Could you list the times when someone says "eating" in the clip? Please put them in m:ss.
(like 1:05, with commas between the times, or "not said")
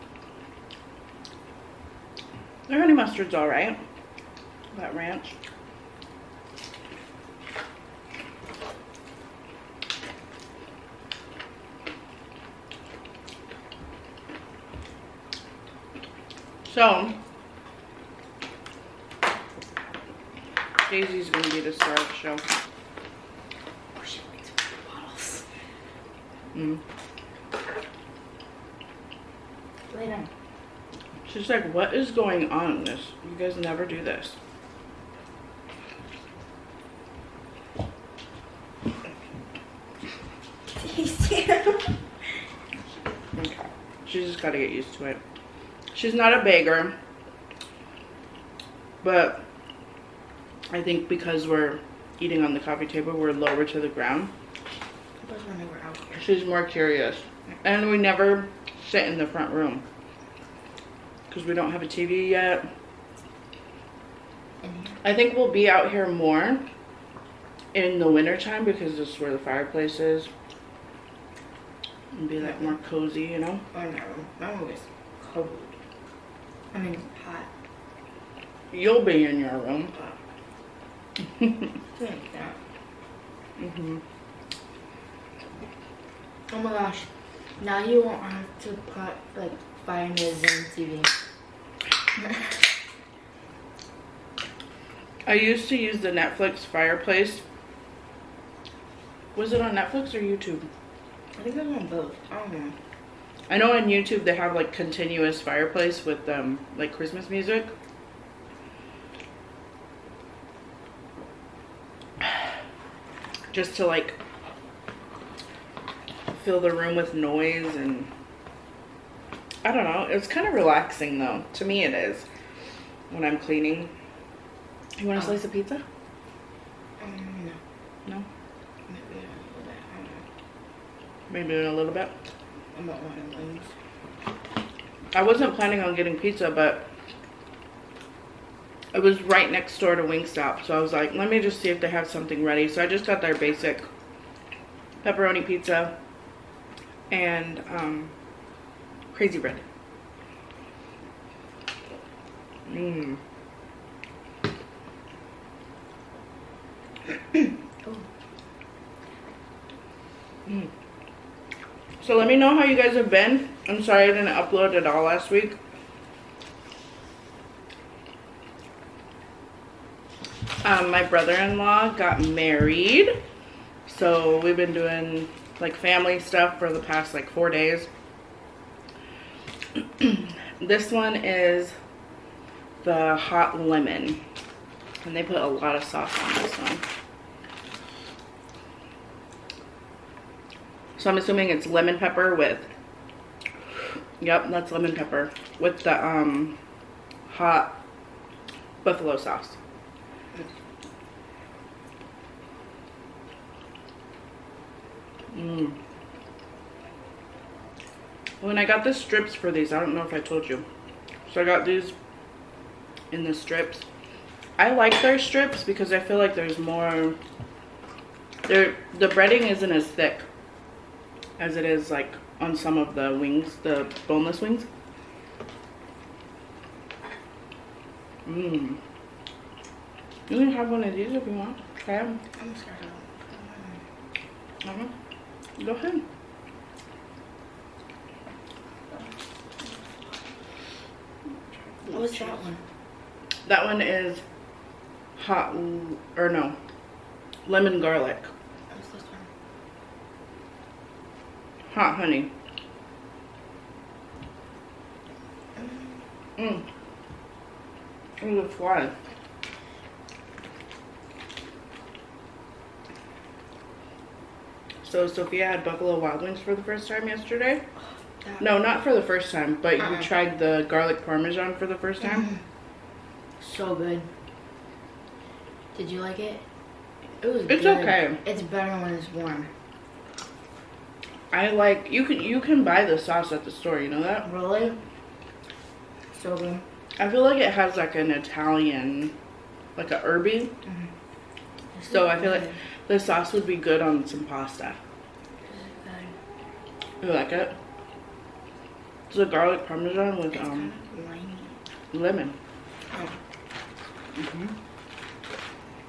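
0:52.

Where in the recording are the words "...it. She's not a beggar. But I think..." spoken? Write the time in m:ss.
0:45.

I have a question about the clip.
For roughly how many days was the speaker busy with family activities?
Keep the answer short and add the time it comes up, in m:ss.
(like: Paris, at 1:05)
4, at 2:57.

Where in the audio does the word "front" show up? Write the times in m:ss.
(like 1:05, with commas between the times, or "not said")
0:59.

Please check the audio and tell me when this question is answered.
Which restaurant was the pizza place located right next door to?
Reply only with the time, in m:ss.
2:20.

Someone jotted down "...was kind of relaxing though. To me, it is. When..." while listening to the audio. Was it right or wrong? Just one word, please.
right.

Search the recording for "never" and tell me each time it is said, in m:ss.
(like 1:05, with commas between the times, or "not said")
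0:33, 0:57.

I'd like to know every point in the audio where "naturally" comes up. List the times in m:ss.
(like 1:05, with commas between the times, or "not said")
not said.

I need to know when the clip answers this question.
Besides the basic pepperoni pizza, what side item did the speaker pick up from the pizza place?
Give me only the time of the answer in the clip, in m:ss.
2:29.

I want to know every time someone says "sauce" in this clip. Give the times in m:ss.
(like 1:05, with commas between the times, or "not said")
3:05, 3:19, 4:42, 4:52.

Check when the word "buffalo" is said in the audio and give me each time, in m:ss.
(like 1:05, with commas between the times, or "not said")
3:18, 4:25.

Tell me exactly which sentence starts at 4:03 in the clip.
That one is hot or no, lemon garlic.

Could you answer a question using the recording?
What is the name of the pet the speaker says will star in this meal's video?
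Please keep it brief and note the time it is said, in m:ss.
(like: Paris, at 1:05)
Daisy, at 0:20.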